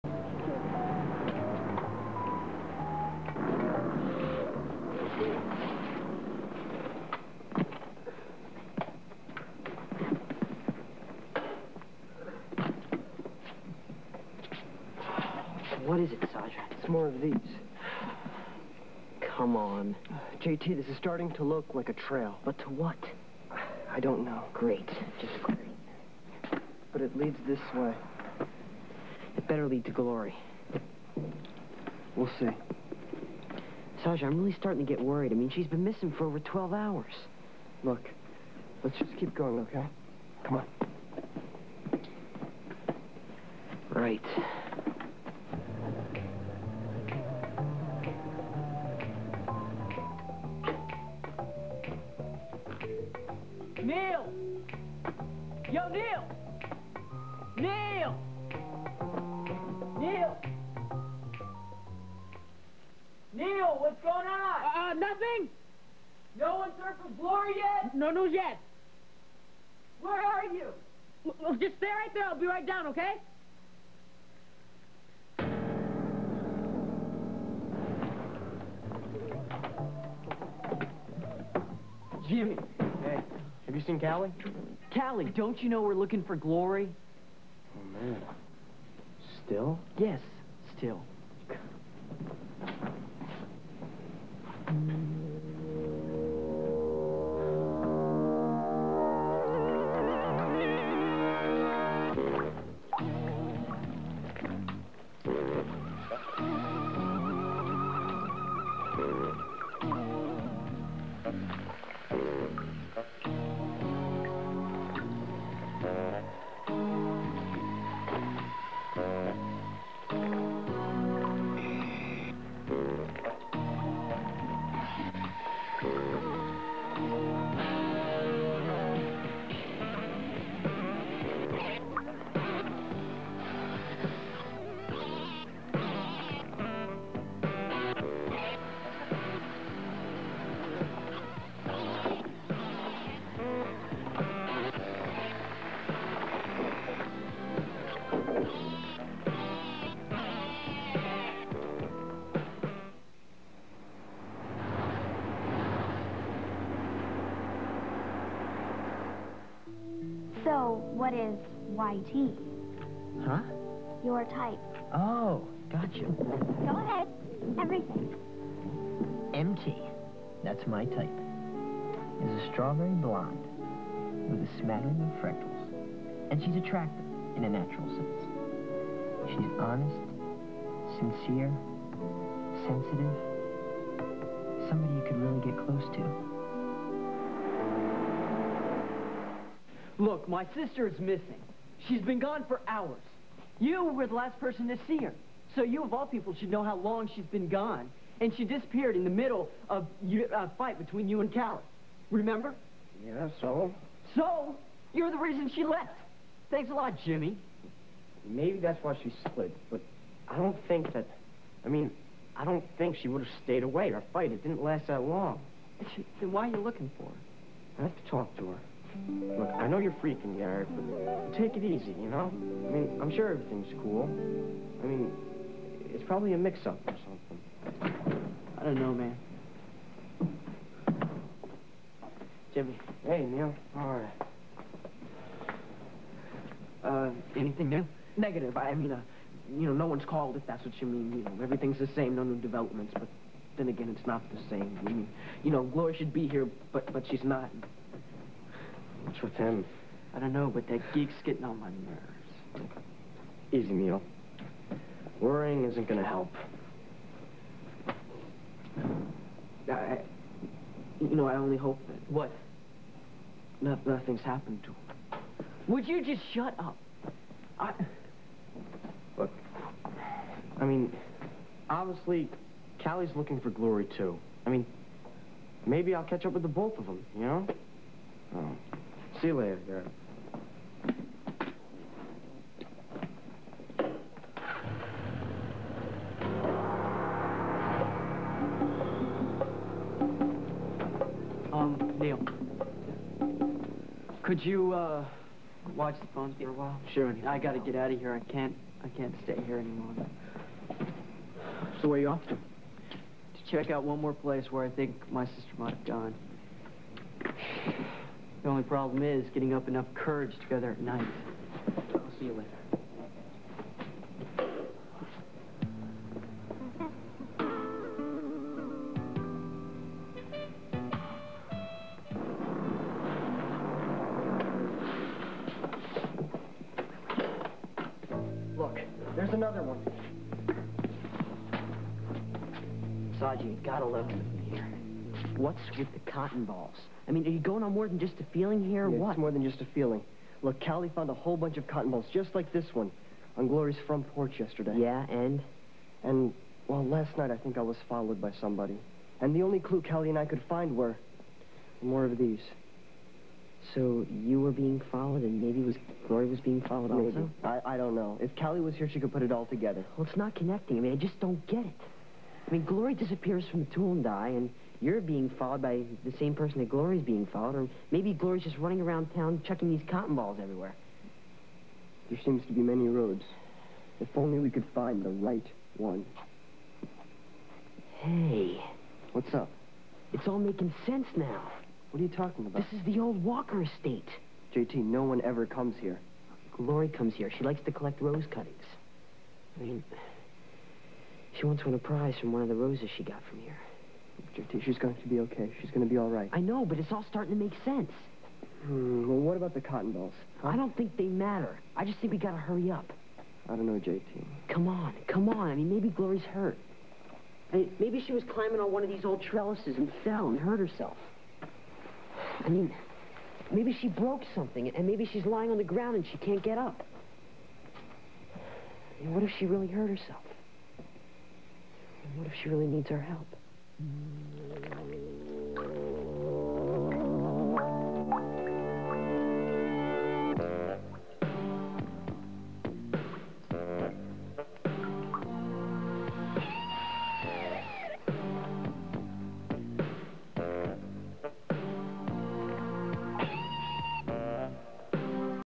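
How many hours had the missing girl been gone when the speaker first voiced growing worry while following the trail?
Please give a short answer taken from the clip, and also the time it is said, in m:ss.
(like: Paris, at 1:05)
12, at 0:36.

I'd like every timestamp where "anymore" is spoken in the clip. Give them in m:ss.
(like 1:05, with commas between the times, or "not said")
4:59.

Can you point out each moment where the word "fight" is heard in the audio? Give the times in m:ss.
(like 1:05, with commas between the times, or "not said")
3:20, 3:34.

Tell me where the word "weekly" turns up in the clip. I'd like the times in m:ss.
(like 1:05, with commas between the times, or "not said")
not said.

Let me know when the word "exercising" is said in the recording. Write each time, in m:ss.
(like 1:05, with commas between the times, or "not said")
not said.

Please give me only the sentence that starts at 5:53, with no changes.
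So you were being followed and maybe was Glory was being followed maybe.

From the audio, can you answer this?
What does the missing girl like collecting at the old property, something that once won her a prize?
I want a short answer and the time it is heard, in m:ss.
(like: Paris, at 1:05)
rose cuttings, at 6:28.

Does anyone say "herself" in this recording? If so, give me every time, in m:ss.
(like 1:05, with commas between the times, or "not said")
6:50, 6:59.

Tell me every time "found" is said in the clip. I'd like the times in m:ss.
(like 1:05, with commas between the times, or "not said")
5:40.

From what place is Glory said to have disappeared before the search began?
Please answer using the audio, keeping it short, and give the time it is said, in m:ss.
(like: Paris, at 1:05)
the Tool and Die, at 6:03.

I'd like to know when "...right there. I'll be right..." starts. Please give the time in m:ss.
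1:11.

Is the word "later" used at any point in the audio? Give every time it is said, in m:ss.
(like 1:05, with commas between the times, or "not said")
4:39, 5:12.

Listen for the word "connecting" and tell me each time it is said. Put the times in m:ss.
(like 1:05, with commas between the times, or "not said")
6:00.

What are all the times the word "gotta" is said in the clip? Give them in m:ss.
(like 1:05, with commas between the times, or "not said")
4:57, 5:33, 6:42.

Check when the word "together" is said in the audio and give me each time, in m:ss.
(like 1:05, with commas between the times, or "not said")
5:10, 5:59.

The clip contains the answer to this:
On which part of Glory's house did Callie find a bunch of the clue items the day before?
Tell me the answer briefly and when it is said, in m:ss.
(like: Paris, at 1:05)
front porch, at 5:43.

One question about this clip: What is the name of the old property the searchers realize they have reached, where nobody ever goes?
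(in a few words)
Walker estate.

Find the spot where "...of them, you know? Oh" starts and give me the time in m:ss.
4:36.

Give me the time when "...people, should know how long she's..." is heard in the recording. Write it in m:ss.
3:16.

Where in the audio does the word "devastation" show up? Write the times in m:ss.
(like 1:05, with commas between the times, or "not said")
not said.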